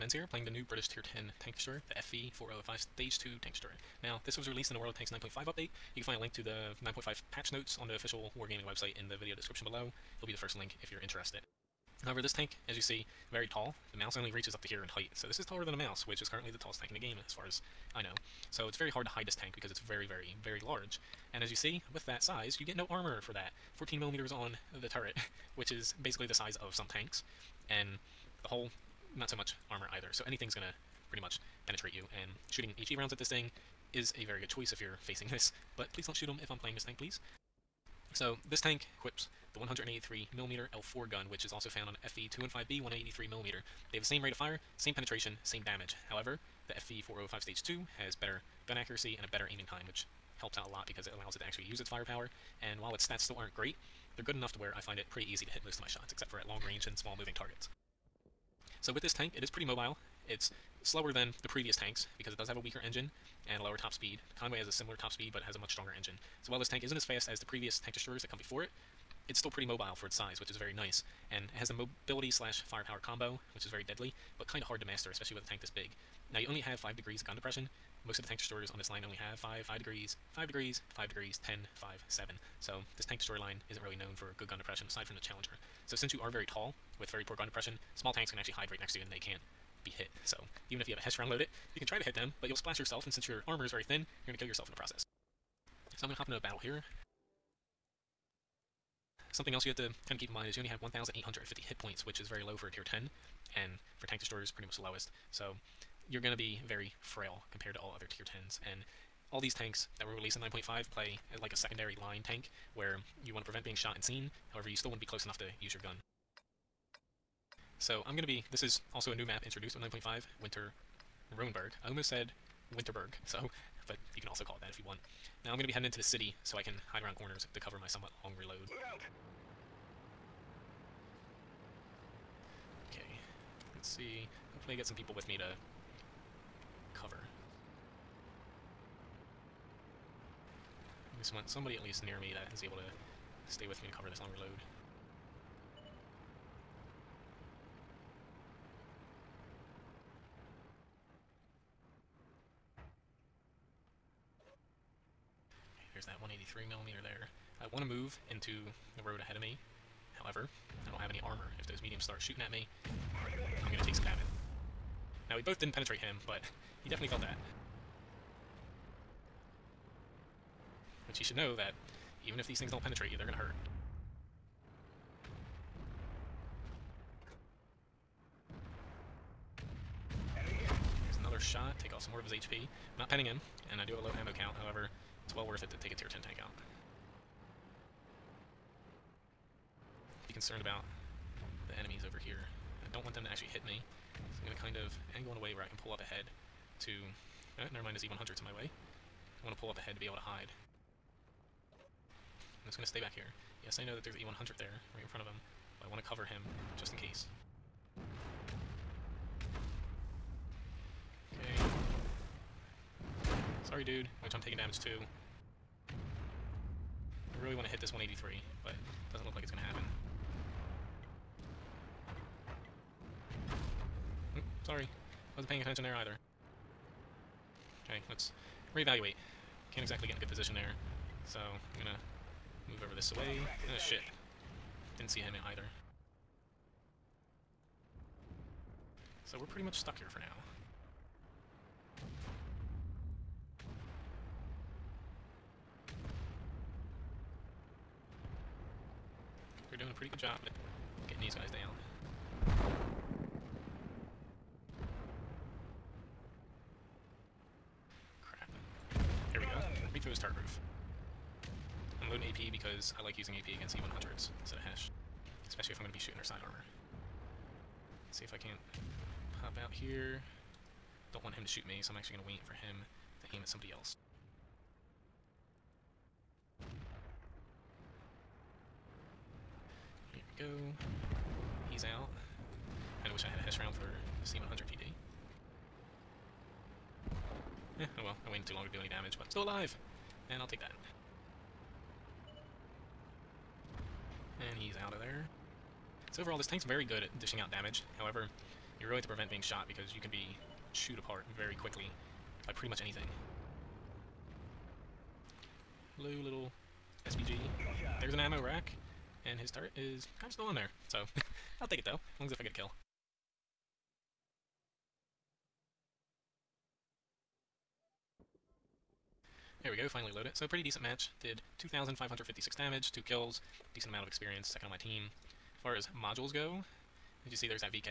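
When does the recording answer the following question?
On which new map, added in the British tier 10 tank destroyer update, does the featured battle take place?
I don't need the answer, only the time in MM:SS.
02:00.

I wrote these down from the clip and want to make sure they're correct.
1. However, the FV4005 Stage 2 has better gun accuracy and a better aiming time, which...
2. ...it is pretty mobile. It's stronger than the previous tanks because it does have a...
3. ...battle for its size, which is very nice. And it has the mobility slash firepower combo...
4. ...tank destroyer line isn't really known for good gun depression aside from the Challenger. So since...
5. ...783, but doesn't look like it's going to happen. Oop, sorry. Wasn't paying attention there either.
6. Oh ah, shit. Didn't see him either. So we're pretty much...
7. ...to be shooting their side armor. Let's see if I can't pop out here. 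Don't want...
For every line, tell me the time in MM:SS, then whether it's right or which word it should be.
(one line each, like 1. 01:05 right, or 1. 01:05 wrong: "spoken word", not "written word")
1. 00:46 right
2. 00:59 wrong: "slower", not "stronger"
3. 01:09 wrong: "mobile", not "battle"
4. 01:23 right
5. 03:37 wrong: "183", not "783"
6. 03:53 right
7. 04:25 right.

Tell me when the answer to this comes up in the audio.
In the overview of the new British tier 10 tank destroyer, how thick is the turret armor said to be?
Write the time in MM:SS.
00:23.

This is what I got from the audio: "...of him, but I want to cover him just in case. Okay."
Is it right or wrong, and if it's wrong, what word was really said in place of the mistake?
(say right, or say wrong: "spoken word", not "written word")
right.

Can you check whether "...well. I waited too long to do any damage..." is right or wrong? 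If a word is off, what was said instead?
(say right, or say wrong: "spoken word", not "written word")
right.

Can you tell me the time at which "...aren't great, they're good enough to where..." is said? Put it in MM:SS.
00:53.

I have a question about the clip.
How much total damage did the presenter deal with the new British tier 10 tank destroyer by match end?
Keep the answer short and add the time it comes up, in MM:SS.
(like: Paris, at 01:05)
2,556, at 05:21.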